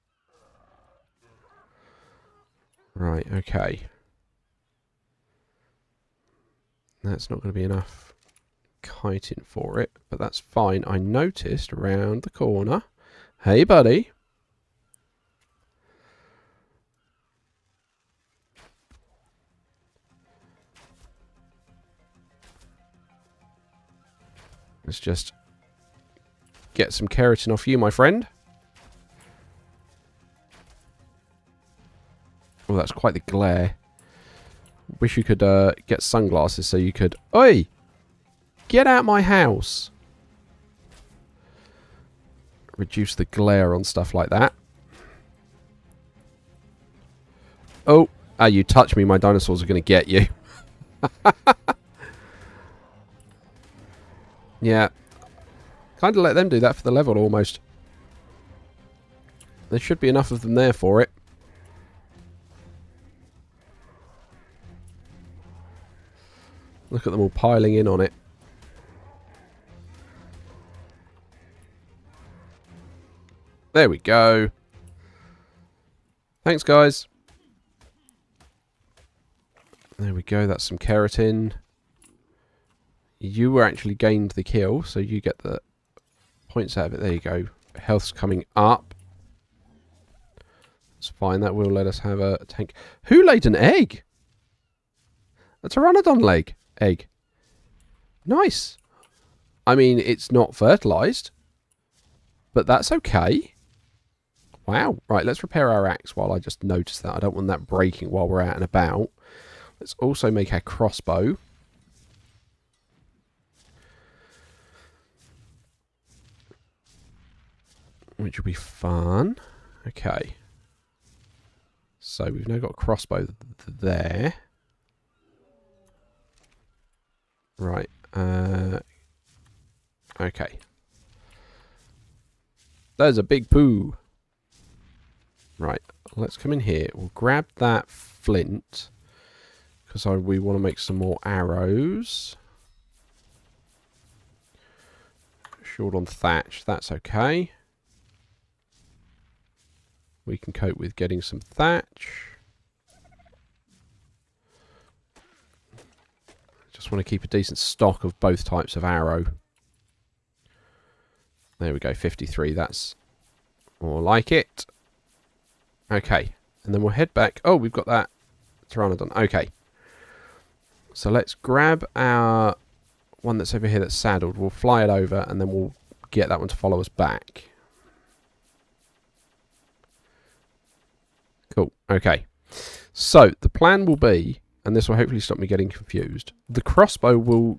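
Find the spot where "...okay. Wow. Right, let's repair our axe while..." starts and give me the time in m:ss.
1:42.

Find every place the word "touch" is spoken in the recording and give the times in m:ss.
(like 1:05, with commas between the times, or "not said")
0:48.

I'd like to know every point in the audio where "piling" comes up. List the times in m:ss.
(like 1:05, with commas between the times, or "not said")
1:07.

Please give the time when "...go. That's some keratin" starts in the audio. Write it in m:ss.
1:20.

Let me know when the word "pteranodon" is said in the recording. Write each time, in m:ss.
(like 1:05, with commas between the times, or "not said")
1:35, 2:48.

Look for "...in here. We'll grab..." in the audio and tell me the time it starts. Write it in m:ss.
2:16.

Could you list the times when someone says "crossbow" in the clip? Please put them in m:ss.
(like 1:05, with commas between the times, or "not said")
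1:50, 2:02, 3:06.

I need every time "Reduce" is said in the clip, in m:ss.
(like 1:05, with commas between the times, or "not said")
0:42.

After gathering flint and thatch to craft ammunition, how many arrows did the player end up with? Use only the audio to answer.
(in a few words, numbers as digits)
53.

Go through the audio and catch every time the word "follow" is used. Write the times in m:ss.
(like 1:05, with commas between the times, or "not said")
2:56.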